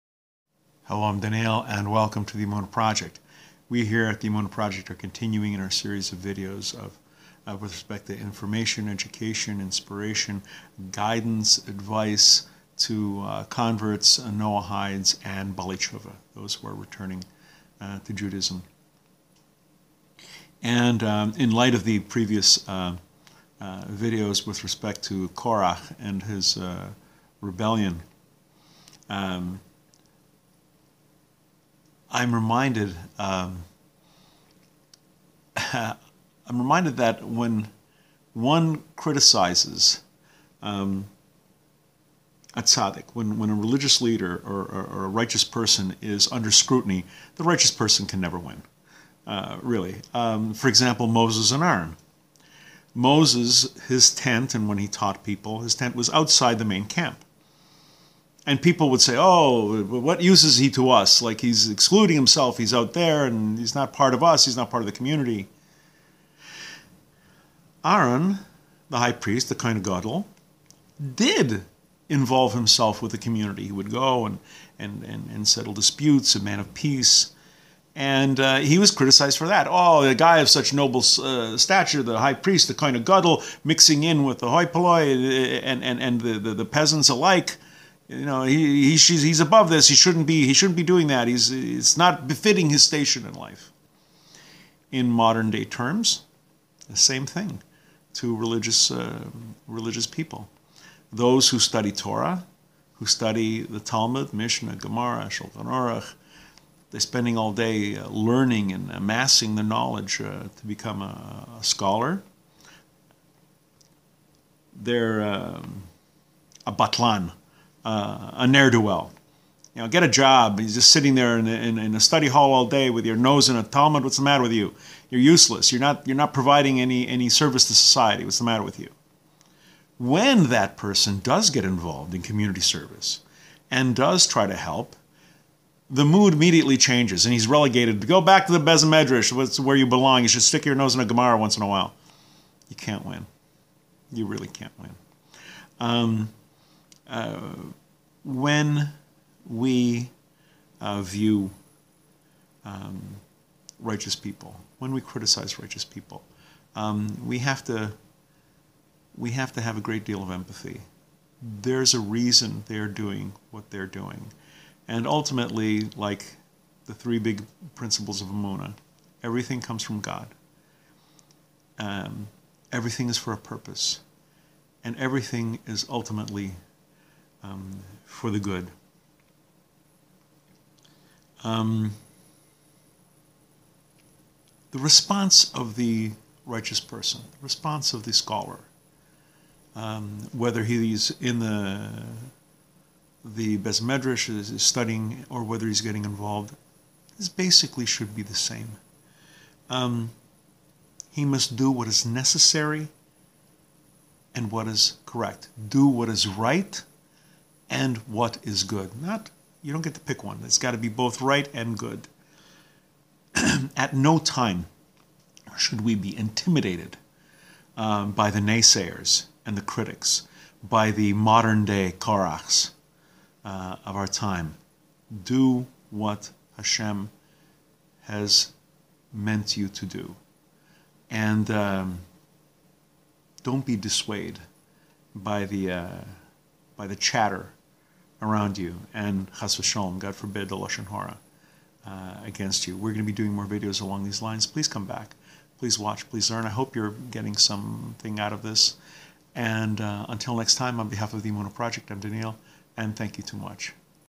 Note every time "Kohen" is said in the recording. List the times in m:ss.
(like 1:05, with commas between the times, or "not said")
1:09, 1:22.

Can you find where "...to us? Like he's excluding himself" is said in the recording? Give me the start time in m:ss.
1:00.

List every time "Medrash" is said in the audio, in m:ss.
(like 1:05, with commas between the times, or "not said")
2:18, 3:13.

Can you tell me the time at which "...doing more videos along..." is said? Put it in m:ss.
4:03.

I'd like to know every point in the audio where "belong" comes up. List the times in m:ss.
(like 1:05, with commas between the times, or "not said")
2:19.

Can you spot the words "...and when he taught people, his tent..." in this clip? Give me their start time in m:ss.
0:54.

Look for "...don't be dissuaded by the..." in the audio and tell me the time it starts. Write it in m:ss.
3:53.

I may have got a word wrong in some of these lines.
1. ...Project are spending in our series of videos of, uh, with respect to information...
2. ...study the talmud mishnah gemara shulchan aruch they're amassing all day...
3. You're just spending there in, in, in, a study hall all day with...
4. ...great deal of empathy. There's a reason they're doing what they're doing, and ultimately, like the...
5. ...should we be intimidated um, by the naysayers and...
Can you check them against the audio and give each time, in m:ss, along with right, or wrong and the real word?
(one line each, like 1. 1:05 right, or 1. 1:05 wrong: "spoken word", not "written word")
1. 0:04 wrong: "continuing", not "spending"
2. 1:43 wrong: "spending", not "amassing"
3. 2:00 wrong: "sitting", not "spending"
4. 2:39 right
5. 3:35 right.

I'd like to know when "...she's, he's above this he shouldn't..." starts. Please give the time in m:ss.
1:28.